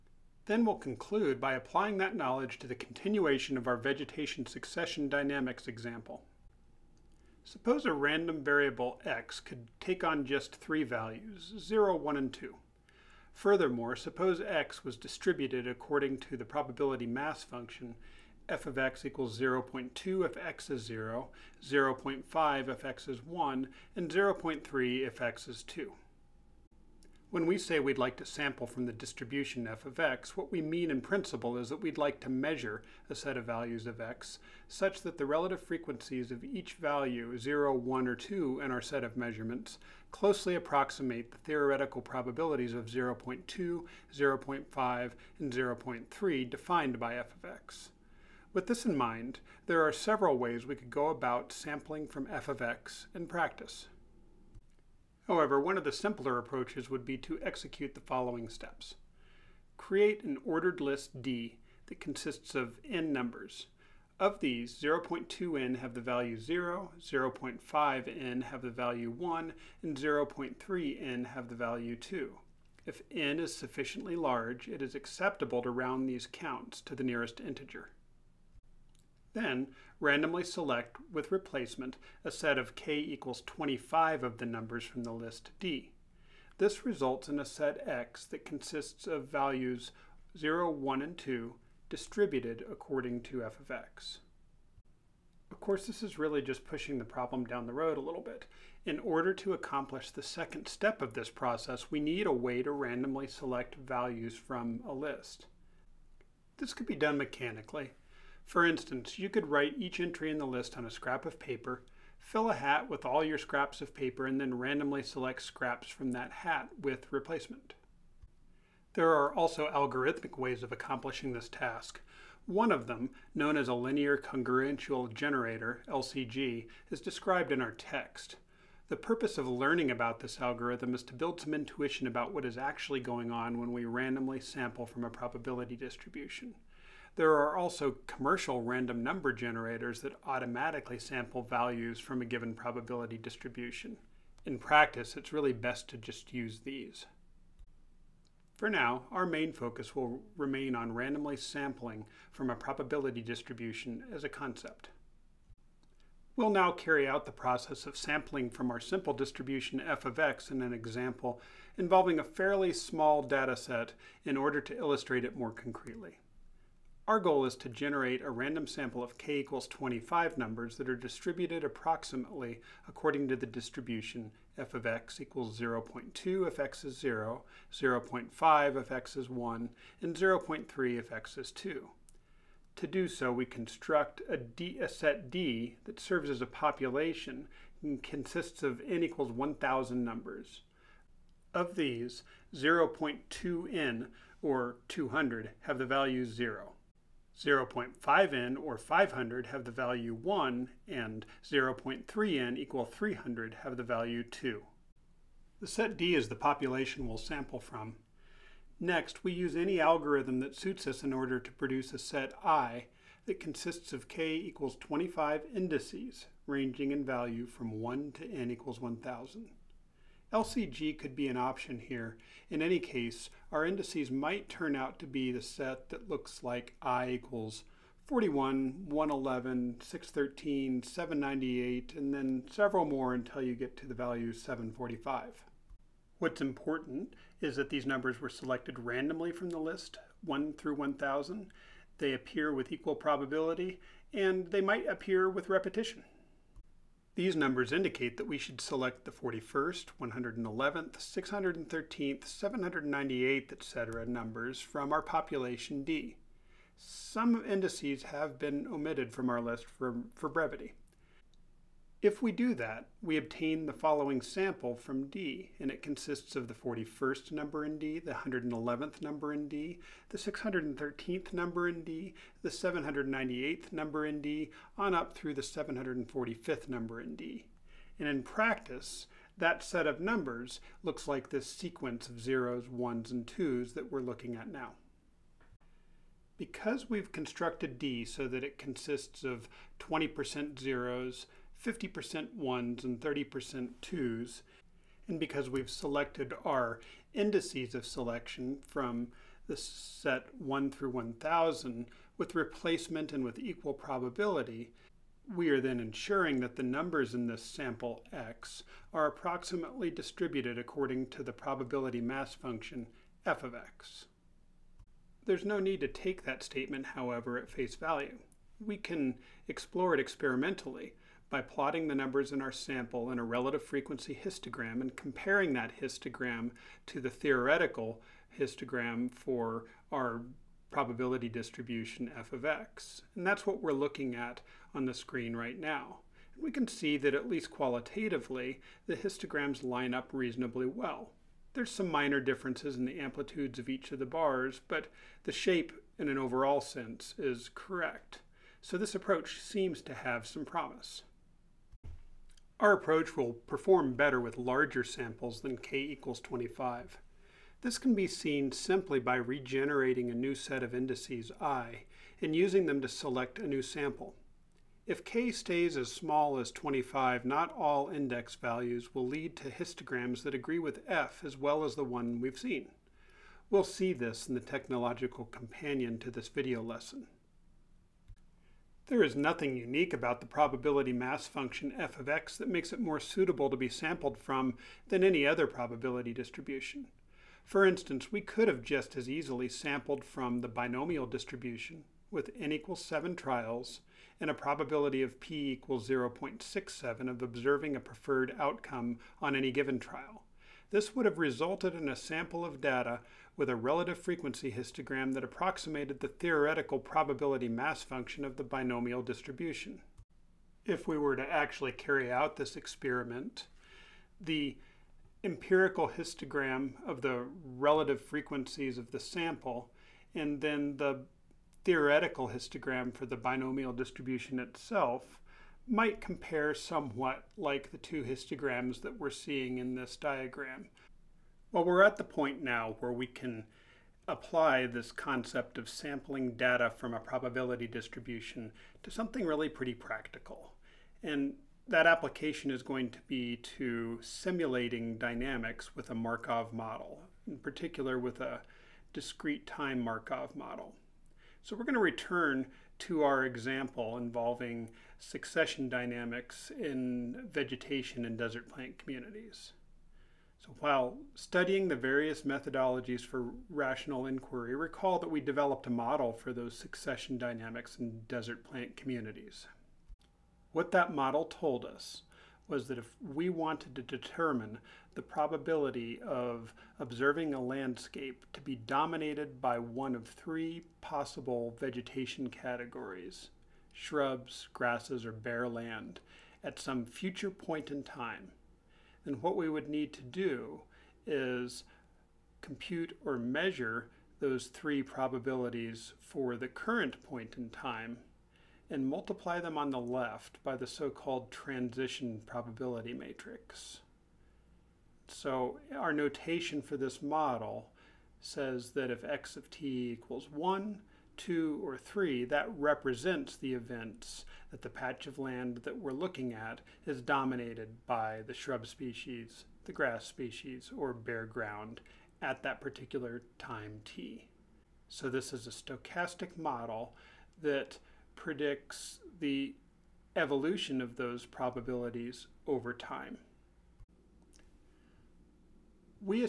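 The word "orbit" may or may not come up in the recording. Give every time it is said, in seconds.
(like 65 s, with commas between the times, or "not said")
not said.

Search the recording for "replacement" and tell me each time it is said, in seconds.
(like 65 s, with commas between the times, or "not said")
81 s, 117 s, 302 s.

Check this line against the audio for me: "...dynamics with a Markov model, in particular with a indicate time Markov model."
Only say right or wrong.
wrong.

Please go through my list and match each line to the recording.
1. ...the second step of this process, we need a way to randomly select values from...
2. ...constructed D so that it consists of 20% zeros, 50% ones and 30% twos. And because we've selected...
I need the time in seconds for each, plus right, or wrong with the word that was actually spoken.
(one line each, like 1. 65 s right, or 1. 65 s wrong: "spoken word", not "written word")
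1. 100 s right
2. 287 s right.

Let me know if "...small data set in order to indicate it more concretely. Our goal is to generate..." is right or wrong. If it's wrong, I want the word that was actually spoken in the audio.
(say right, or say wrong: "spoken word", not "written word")
wrong: "illustrate", not "indicate".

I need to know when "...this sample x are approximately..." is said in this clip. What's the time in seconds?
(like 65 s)
307 s.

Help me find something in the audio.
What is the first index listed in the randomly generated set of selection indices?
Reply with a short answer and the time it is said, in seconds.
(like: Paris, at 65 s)
41, at 228 s.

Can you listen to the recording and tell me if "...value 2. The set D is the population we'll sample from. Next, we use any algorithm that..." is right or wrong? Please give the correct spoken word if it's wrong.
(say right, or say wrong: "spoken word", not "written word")
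right.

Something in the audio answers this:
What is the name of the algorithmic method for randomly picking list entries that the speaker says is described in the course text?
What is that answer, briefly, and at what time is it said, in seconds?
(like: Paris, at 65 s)
linear congruential generator, at 123 s.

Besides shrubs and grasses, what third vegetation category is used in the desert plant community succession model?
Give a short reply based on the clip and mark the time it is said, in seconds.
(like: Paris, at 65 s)
bare land, at 485 s.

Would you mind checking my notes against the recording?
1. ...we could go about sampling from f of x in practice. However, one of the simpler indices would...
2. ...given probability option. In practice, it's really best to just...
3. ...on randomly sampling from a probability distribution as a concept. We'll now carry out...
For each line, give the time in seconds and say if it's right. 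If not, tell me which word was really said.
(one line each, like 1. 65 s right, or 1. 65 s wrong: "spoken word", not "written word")
1. 50 s wrong: "approaches", not "indices"
2. 142 s wrong: "distribution", not "option"
3. 150 s right.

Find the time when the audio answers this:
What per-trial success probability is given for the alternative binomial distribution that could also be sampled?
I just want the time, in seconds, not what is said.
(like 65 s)
395 s.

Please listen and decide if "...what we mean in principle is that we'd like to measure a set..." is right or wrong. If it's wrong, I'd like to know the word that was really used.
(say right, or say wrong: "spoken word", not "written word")
right.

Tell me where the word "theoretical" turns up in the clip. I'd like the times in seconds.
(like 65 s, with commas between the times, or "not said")
41 s, 327 s, 406 s, 421 s.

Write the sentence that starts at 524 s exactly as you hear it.
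So this is a stochastic model that predicts the evolution of those probabilities over time.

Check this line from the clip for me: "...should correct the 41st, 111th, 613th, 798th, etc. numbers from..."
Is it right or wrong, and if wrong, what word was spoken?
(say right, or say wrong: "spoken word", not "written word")
wrong: "select", not "correct".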